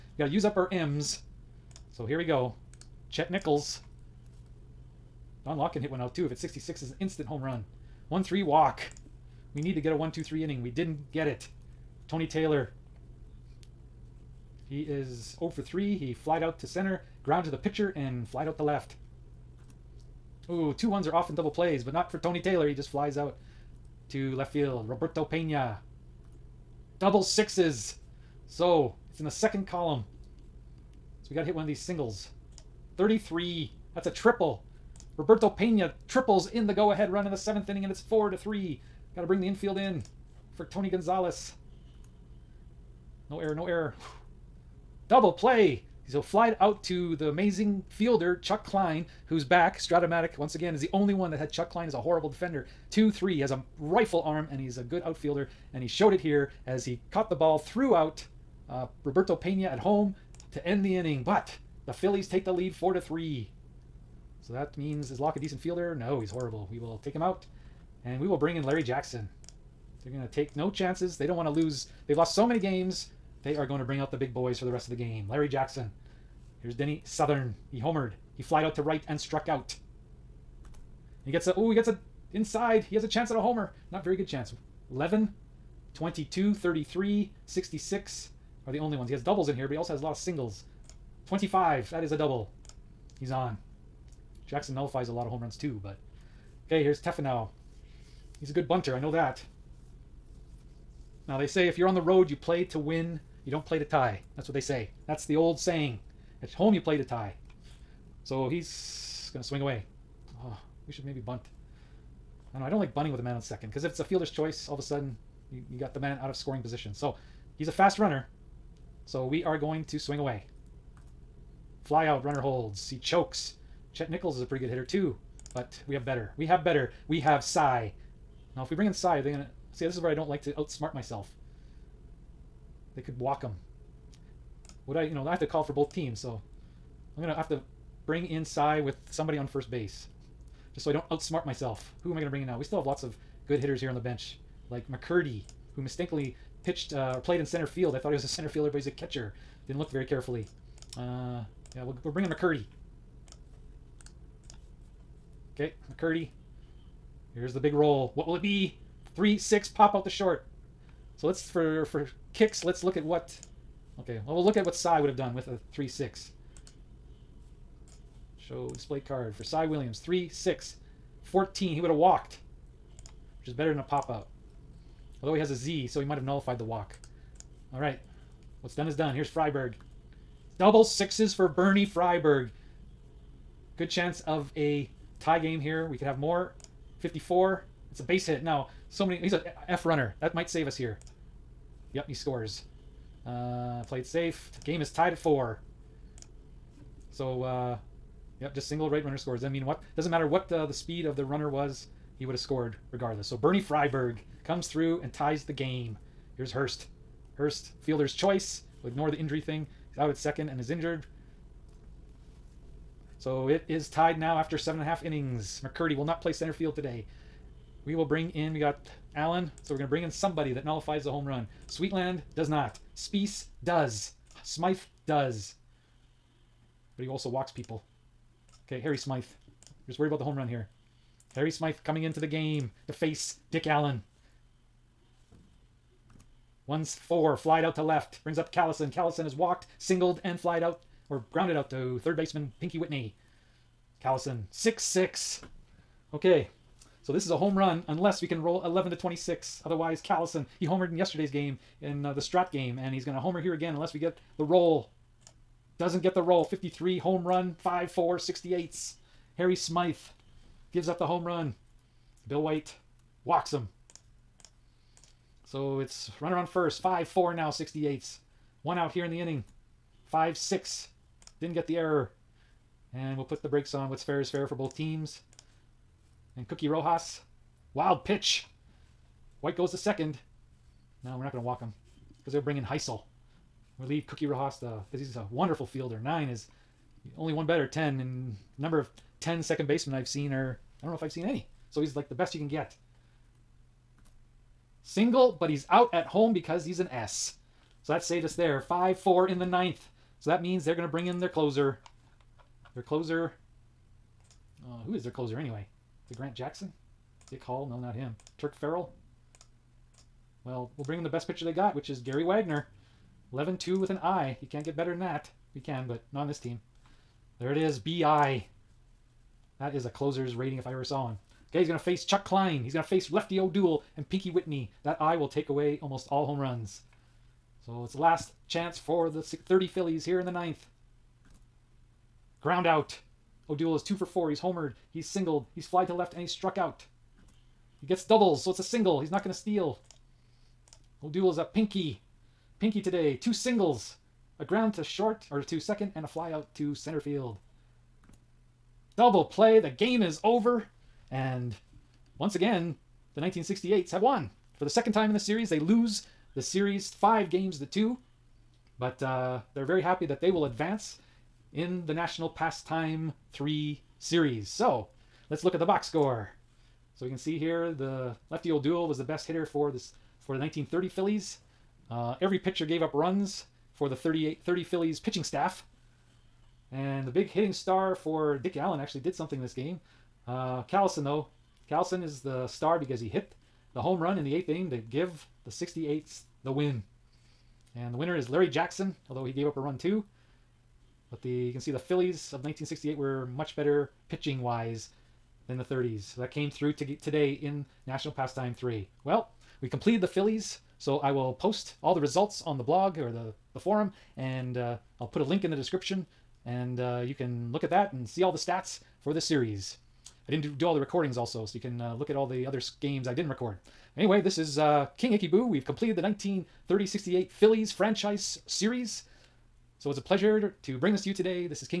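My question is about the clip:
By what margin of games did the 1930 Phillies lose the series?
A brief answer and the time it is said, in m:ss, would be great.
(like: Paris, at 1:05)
5 games to 2, at 5:56.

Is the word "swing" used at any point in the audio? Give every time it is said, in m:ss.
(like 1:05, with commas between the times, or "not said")
1:49, 1:59.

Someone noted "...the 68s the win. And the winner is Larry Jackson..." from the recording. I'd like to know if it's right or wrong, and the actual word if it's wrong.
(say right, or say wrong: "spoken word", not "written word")
right.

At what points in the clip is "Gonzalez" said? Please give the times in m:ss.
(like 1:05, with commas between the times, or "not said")
0:40.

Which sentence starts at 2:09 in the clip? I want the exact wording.
See, this is where I don't like to outsmart myself.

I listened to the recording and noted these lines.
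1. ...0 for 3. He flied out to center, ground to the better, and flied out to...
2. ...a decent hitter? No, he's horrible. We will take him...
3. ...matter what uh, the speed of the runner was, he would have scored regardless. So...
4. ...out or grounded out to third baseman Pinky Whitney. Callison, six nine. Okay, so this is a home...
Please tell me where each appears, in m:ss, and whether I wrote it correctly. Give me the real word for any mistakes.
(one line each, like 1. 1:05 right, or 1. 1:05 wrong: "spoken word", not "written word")
1. 0:15 wrong: "pitcher", not "better"
2. 1:05 wrong: "fielder", not "hitter"
3. 3:20 right
4. 4:00 wrong: "six", not "nine".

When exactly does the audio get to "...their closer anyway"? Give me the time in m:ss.
5:05.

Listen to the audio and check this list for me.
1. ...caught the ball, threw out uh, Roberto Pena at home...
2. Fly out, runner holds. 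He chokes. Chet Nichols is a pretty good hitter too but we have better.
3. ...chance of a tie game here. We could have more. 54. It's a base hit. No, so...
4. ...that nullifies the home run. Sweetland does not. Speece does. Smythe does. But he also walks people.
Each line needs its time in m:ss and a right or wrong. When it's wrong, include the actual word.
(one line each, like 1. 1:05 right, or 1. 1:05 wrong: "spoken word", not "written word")
1. 0:57 right
2. 2:01 right
3. 3:03 right
4. 3:40 right.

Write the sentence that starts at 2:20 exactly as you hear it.
Just so I don't outsmart myself.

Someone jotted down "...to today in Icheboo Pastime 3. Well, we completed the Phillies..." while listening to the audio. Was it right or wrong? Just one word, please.
wrong.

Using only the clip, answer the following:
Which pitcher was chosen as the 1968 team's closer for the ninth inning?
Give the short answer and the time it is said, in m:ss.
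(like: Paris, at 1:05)
Gary Wagner, at 5:11.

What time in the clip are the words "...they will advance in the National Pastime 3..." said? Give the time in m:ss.
6:00.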